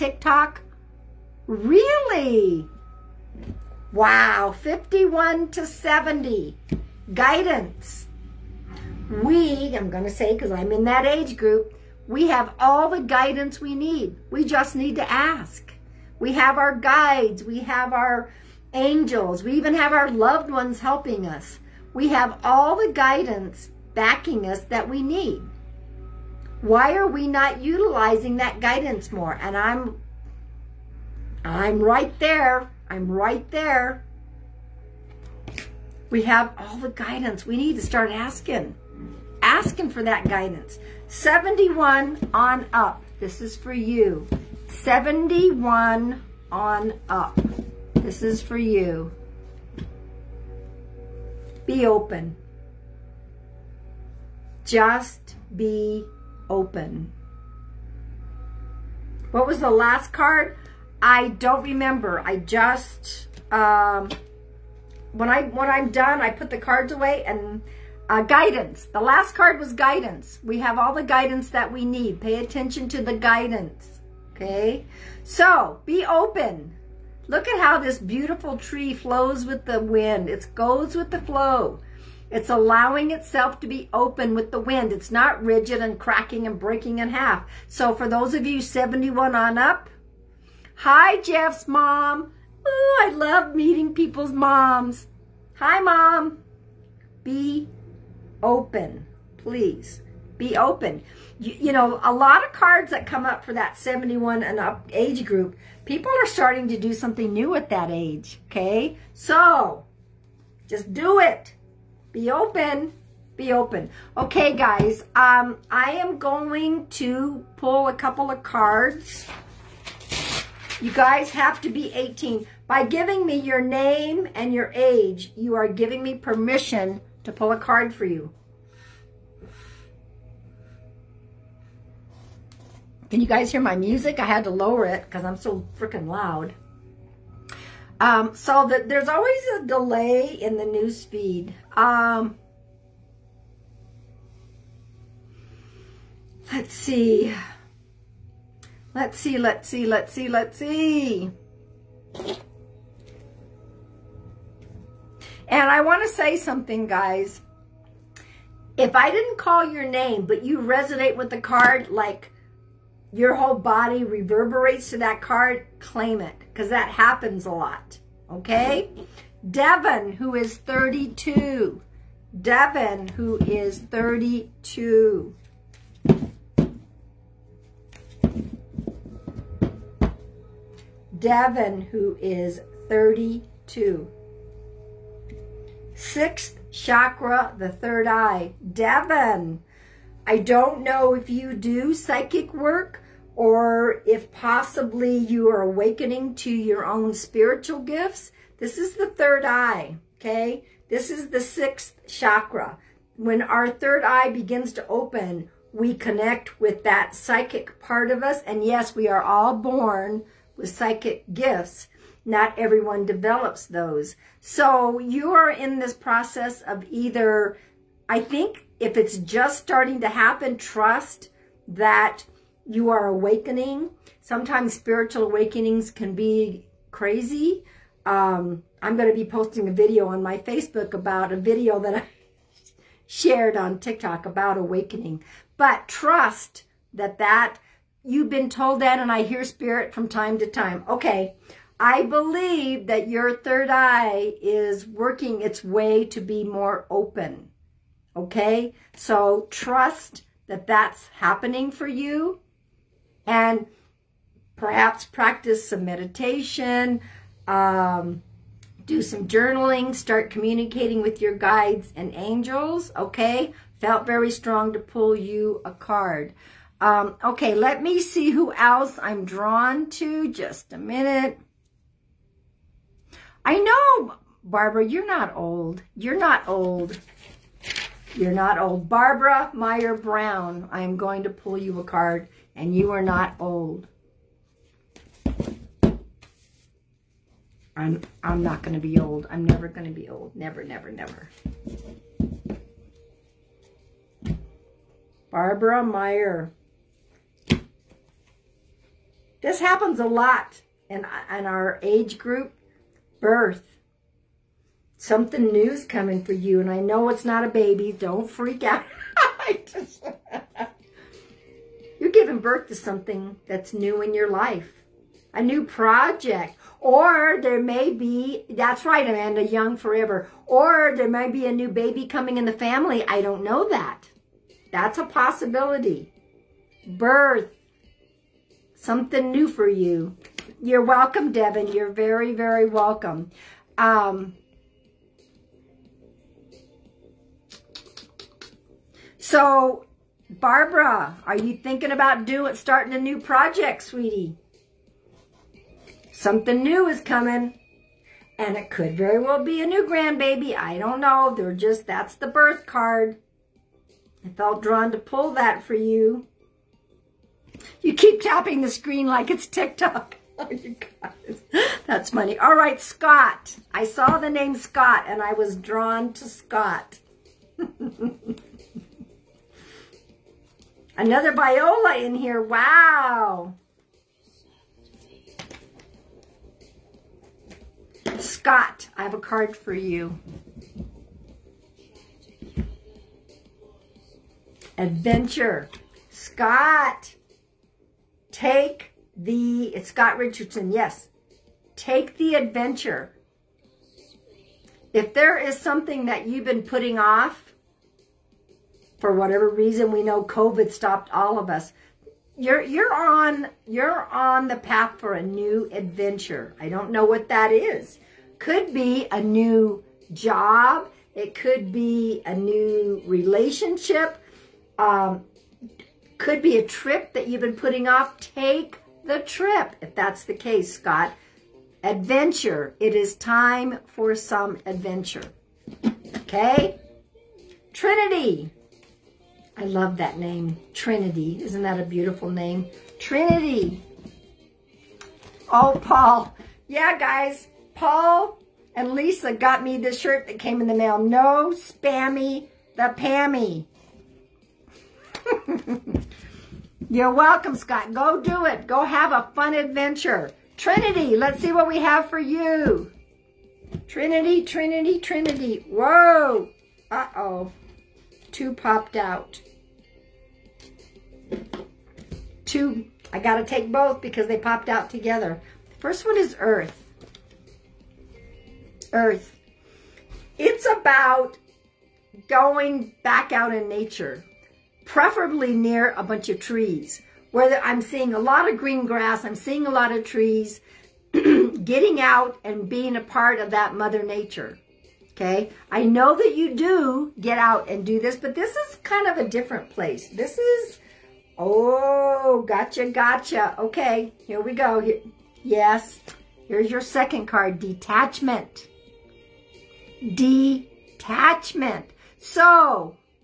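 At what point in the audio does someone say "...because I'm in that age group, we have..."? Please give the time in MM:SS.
00:10.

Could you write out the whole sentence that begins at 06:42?
You're, you're, on, you're on the path for a new adventure.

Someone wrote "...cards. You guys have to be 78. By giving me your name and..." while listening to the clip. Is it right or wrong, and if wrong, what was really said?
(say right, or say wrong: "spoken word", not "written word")
wrong: "18", not "78".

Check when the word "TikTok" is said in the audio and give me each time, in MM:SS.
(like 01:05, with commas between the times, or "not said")
03:53, 05:59.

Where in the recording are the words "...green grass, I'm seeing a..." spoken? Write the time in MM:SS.
07:58.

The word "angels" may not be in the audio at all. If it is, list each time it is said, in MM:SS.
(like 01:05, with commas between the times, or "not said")
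00:18, 04:22.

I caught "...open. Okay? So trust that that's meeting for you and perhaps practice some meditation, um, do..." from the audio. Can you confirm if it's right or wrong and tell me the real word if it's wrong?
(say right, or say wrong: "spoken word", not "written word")
wrong: "happening", not "meeting".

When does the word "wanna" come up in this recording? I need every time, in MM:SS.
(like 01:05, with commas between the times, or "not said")
not said.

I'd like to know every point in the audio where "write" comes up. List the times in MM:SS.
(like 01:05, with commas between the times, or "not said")
not said.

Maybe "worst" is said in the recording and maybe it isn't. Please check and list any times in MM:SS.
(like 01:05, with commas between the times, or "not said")
not said.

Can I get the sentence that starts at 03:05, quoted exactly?
Sixth chakra, the third eye, Devon.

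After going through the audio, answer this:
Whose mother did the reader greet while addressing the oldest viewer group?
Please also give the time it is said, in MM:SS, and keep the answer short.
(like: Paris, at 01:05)
Jeff's, at 01:31.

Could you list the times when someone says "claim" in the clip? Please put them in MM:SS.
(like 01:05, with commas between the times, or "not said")
02:45.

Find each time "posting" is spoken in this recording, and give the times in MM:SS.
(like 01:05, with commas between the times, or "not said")
03:49.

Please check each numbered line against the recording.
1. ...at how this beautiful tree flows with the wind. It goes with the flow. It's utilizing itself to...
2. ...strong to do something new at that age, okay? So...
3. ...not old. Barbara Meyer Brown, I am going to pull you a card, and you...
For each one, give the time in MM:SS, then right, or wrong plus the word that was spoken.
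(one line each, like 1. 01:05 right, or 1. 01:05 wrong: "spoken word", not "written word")
1. 01:17 wrong: "allowing", not "utilizing"
2. 01:46 wrong: "starting", not "strong"
3. 04:38 right.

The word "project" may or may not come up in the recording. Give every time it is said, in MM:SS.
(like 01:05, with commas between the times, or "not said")
05:15, 05:43.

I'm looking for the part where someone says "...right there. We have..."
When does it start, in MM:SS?
00:33.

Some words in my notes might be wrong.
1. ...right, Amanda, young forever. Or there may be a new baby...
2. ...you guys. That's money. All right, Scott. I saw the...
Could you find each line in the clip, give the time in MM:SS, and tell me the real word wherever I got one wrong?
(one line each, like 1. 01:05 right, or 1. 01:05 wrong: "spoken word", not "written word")
1. 05:18 right
2. 06:00 right.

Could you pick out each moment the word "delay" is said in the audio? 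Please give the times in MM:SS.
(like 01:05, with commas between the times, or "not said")
02:19.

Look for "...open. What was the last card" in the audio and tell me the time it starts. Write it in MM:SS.
00:56.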